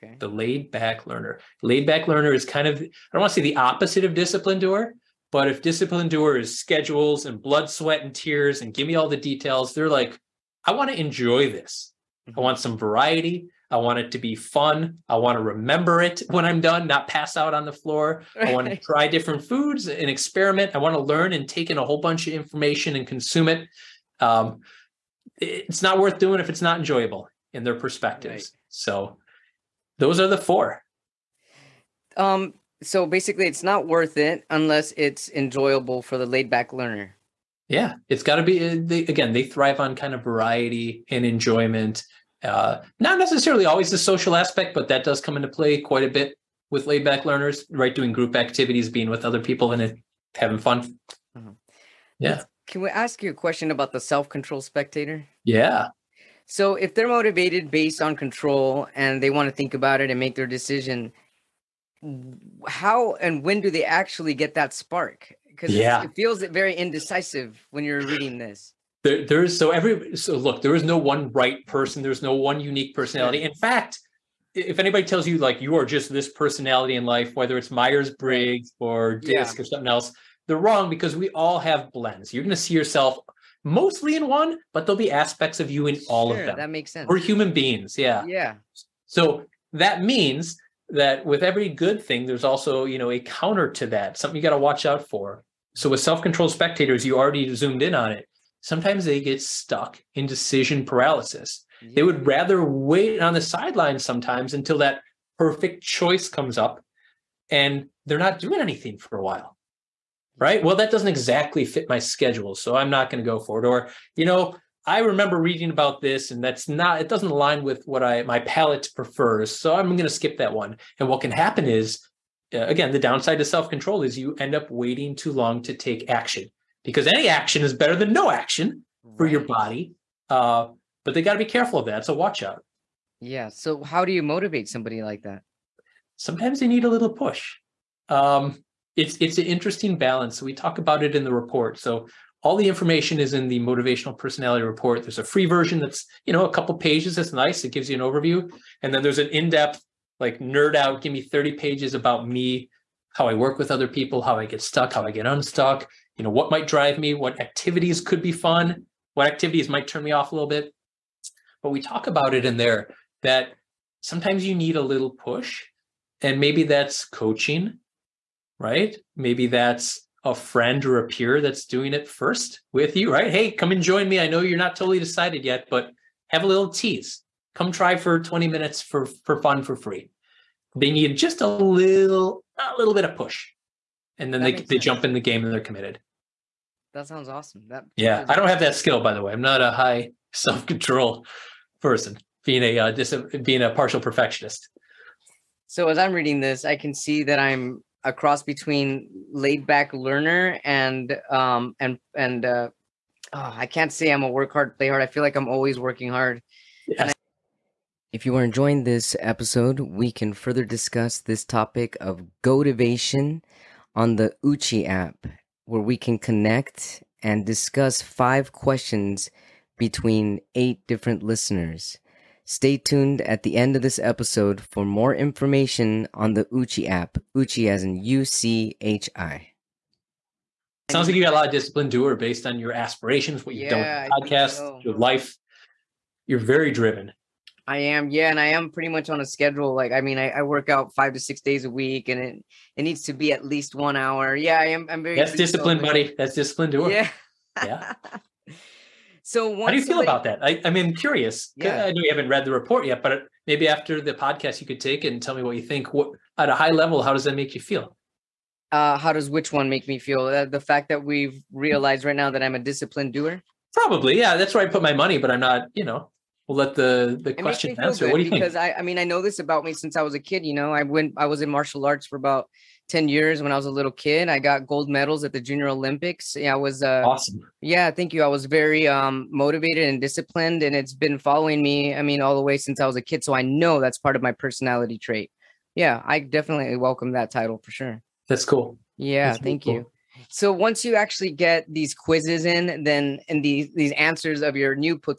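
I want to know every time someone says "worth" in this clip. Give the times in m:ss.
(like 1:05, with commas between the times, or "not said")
0:25, 0:33.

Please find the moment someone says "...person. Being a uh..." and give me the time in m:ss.
3:11.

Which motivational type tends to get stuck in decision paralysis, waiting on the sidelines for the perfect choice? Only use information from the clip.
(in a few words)
self-controlled spectators.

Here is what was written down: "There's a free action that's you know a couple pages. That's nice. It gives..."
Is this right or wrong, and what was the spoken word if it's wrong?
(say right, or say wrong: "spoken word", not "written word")
wrong: "version", not "action".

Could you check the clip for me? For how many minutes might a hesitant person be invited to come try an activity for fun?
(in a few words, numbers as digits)
20.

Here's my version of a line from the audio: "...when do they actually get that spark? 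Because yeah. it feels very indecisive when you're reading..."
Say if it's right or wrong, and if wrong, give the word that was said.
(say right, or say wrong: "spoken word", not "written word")
right.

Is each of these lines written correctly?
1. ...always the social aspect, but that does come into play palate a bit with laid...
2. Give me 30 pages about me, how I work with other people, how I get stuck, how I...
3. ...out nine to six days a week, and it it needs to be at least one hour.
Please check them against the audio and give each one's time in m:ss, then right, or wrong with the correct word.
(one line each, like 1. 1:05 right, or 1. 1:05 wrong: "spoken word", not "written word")
1. 0:43 wrong: "quite", not "palate"
2. 2:31 right
3. 4:00 wrong: "five", not "nine".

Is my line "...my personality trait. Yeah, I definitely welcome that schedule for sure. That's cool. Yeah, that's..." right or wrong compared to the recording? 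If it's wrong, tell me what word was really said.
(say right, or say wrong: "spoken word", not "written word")
wrong: "title", not "schedule".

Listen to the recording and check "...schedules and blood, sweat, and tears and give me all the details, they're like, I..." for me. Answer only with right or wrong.
right.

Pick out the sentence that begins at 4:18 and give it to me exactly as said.
Uh, how does which one make me feel?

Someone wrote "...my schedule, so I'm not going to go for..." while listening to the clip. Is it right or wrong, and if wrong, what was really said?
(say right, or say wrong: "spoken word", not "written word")
right.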